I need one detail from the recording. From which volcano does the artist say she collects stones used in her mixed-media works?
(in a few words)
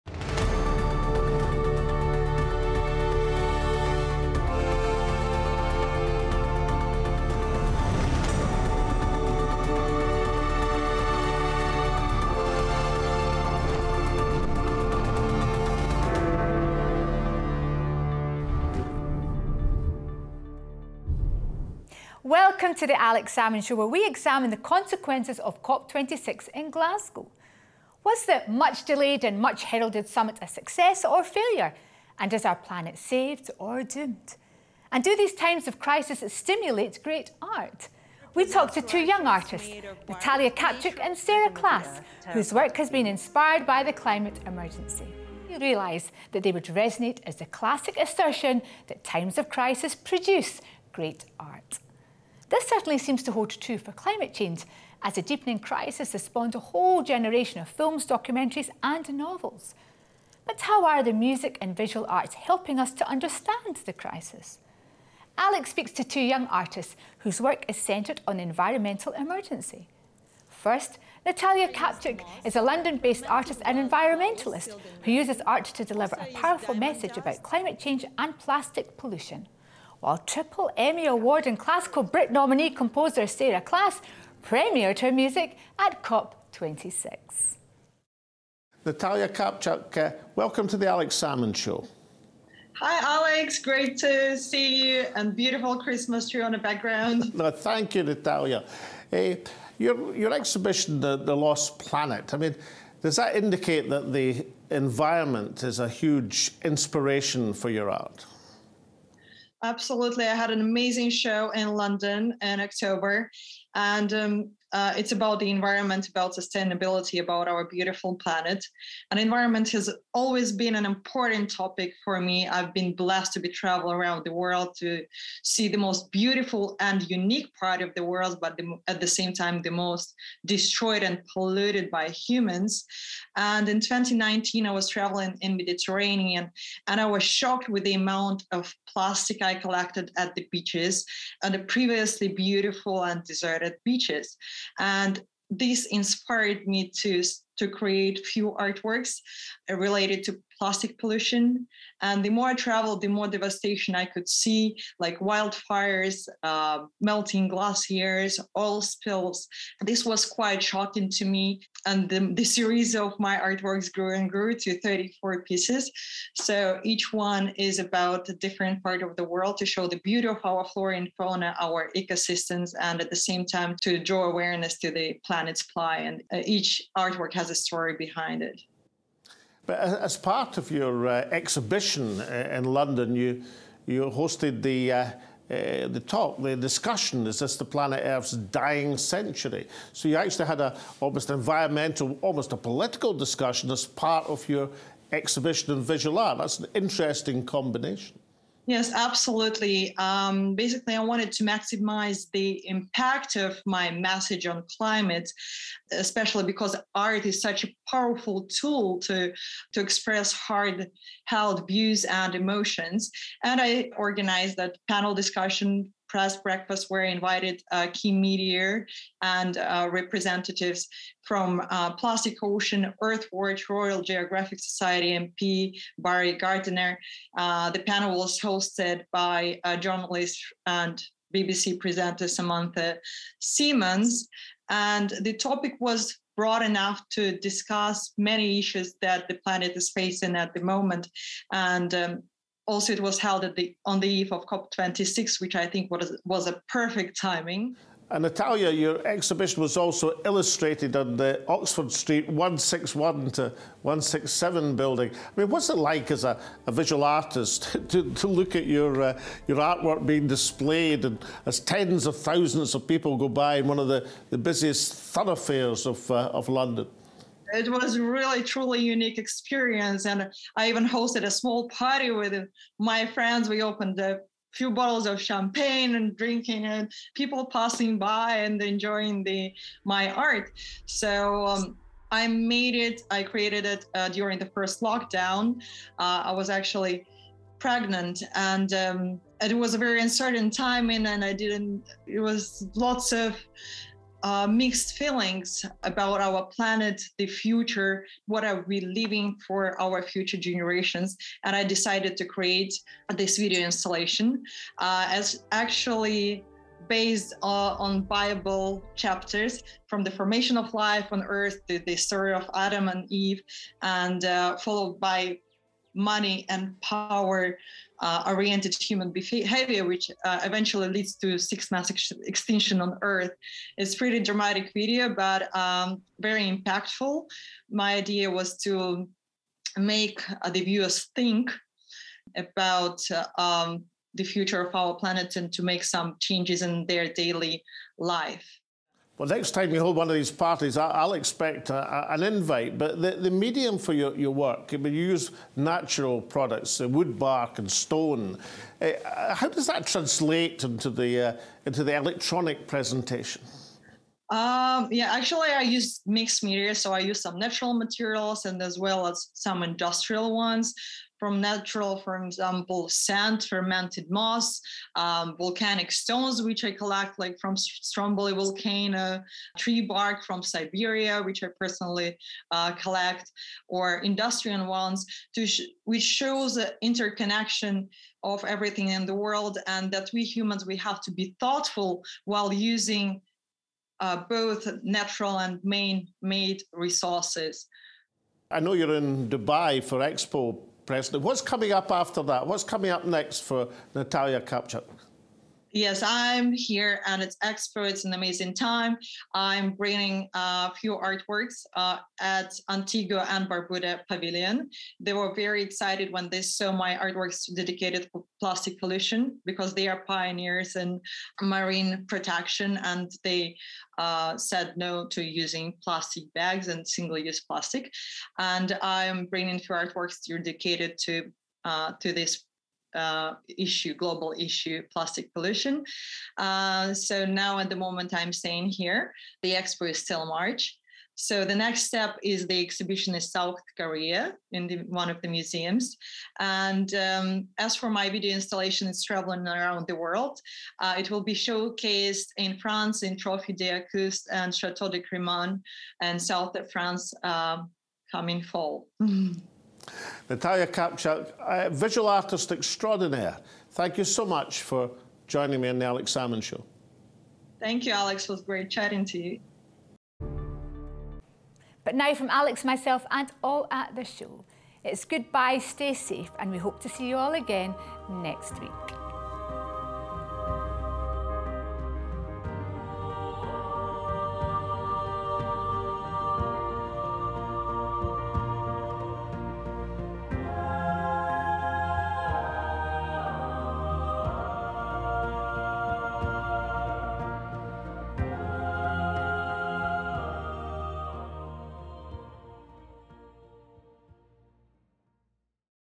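Stromboli.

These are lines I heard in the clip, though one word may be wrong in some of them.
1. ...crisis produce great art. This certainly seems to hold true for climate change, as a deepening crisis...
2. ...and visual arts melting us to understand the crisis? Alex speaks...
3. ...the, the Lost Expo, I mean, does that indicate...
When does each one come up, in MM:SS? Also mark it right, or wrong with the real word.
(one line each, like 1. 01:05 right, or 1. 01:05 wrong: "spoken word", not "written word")
1. 00:49 right
2. 01:01 wrong: "helping", not "melting"
3. 01:40 wrong: "Planet", not "Expo".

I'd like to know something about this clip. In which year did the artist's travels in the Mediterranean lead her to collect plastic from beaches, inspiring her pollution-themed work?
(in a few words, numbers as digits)
2019.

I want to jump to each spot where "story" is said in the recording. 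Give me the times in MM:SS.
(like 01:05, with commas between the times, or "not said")
02:57, 05:11.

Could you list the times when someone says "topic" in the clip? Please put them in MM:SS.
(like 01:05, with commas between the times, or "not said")
02:01, 03:55.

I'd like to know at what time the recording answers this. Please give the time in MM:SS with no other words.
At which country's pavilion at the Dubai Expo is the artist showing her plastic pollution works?
06:42.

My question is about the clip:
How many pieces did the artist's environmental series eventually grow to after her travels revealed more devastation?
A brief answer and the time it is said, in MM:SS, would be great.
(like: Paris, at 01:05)
34, at 02:44.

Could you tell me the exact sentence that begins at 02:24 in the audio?
And this inspired me to to create few artworks uh, related to plastic pollution.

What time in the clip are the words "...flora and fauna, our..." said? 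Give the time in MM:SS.
02:50.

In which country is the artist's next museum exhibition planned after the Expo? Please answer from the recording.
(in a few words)
South Korea.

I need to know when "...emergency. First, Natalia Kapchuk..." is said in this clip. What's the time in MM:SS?
01:09.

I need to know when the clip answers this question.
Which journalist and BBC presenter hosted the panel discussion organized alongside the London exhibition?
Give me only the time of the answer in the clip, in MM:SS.
03:52.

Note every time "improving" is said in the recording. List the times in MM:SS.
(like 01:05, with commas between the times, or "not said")
not said.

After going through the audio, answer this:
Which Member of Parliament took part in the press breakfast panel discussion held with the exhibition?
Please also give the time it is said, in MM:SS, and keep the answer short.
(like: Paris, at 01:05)
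Barry Gardiner, at 03:45.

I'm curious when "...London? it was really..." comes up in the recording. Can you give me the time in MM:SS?
04:26.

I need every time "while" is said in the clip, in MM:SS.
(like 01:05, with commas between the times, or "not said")
01:20, 06:22.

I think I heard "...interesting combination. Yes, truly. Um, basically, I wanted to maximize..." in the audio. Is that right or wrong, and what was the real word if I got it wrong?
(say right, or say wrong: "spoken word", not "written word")
wrong: "absolutely", not "truly".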